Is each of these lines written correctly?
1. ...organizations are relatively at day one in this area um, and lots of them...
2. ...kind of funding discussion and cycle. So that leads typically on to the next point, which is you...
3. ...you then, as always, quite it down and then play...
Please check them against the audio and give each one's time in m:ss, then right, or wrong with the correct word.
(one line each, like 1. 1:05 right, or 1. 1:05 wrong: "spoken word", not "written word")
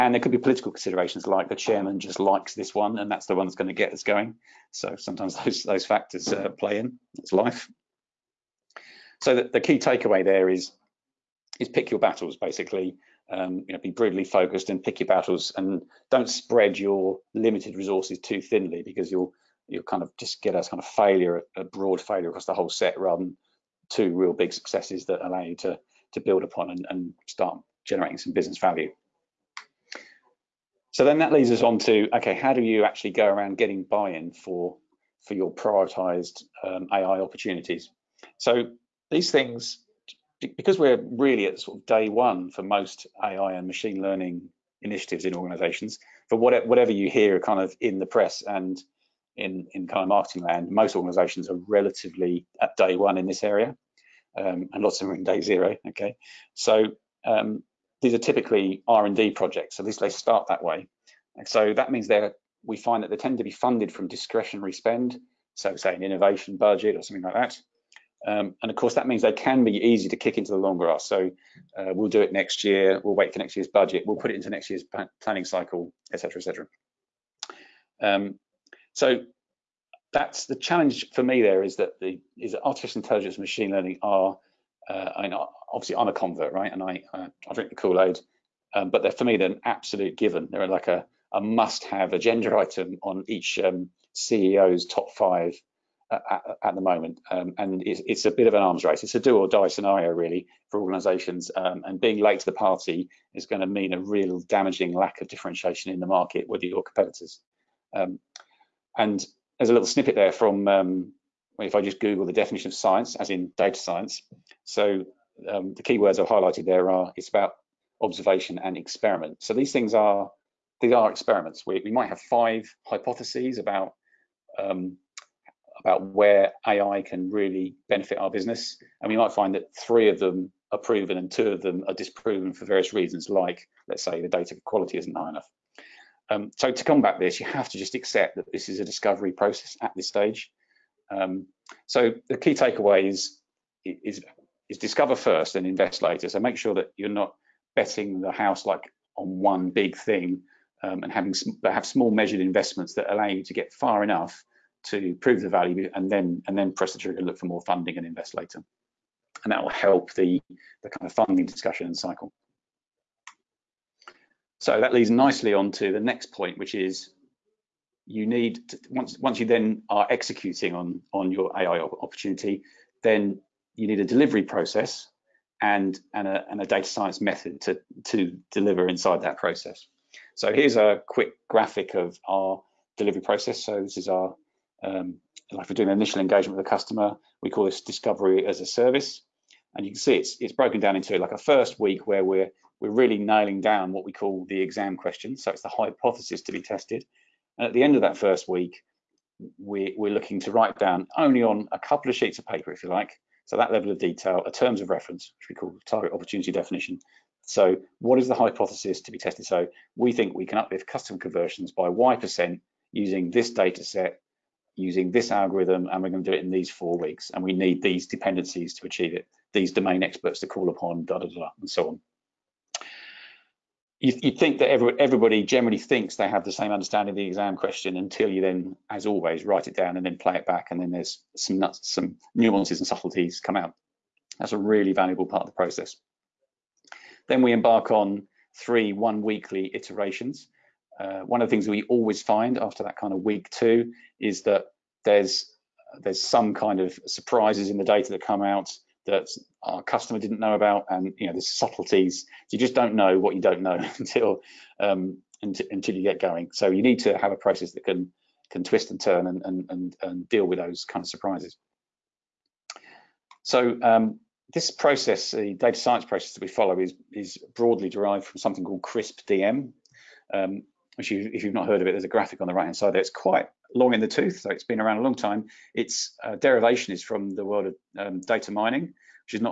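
1. 0:50 right
2. 2:40 wrong: "nicely", not "typically"
3. 3:48 wrong: "write", not "quite".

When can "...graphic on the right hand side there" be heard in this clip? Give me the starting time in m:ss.
4:32.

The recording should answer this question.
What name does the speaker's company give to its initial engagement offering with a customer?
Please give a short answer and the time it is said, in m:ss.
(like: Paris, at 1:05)
discovery as a service, at 3:07.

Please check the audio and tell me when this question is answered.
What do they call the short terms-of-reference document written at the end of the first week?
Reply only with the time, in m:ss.
3:25.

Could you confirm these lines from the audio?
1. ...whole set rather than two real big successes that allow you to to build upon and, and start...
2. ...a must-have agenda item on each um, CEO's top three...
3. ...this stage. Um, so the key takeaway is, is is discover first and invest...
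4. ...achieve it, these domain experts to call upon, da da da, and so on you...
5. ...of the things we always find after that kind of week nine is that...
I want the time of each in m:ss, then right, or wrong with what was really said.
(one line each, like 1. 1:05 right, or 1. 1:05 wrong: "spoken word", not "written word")
1. 0:22 right
2. 1:31 wrong: "five", not "three"
3. 2:19 right
4. 3:38 right
5. 4:01 wrong: "two", not "nine".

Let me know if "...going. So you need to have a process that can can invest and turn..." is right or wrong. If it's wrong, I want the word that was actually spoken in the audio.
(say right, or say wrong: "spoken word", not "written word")
wrong: "twist", not "invest".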